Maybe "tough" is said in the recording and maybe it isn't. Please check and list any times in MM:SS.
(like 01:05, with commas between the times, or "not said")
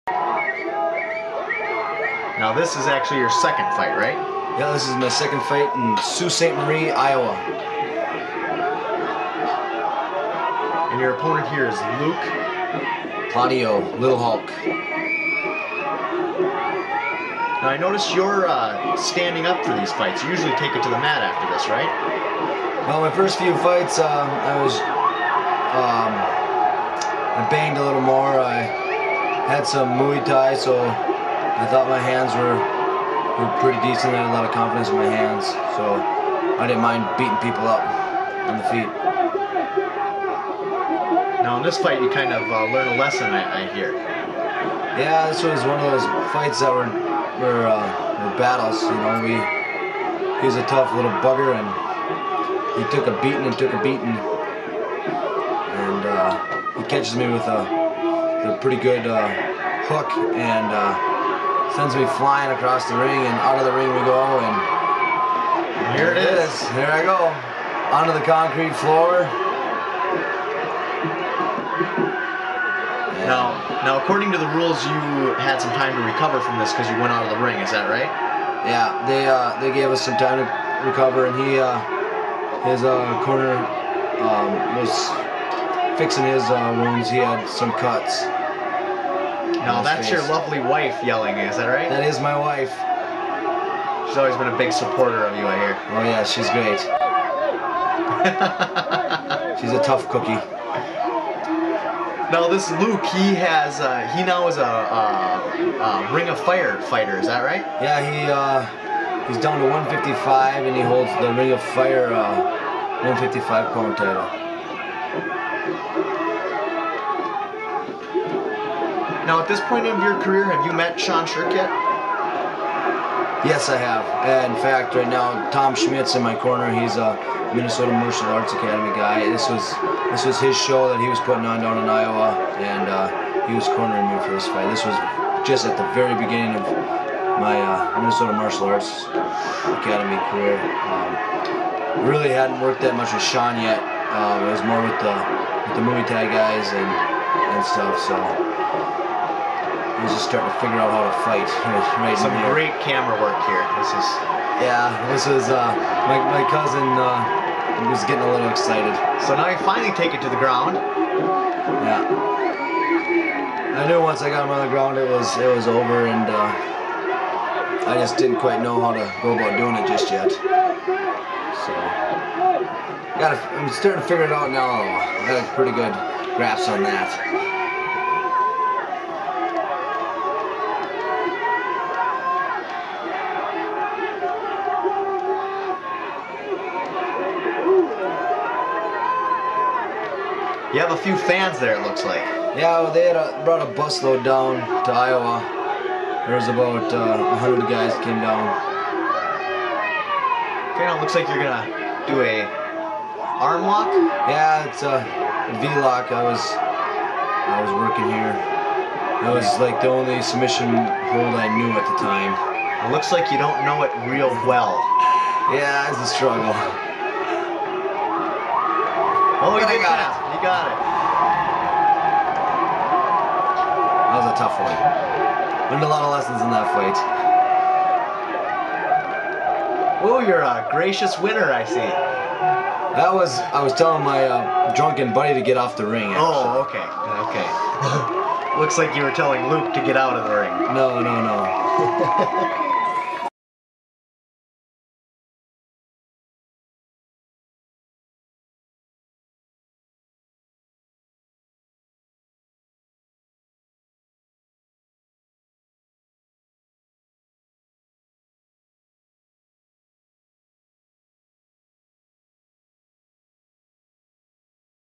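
00:50, 01:39, 03:44.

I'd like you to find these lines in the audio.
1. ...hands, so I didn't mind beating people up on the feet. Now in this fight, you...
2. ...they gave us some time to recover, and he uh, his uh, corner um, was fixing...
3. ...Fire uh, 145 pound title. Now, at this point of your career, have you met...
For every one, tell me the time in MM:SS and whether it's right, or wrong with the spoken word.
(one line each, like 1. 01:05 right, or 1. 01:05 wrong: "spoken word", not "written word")
1. 00:35 right
2. 01:19 right
3. 01:51 wrong: "155", not "145".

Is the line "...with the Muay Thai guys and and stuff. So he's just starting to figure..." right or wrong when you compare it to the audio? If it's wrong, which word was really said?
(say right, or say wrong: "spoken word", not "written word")
right.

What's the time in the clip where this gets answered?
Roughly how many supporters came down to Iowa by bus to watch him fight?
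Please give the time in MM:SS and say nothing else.
03:17.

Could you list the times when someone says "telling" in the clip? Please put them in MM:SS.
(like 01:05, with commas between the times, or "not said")
03:53, 03:59.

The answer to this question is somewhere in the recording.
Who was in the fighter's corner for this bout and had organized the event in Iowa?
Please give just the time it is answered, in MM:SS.
02:05.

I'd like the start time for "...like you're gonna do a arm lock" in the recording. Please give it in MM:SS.
03:21.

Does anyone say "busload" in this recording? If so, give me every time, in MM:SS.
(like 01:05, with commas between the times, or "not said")
03:13.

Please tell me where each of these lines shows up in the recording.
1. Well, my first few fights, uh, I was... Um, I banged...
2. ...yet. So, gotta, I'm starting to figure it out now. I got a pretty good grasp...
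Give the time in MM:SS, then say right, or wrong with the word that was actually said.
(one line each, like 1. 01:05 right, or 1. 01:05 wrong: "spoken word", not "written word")
1. 00:22 right
2. 02:50 right.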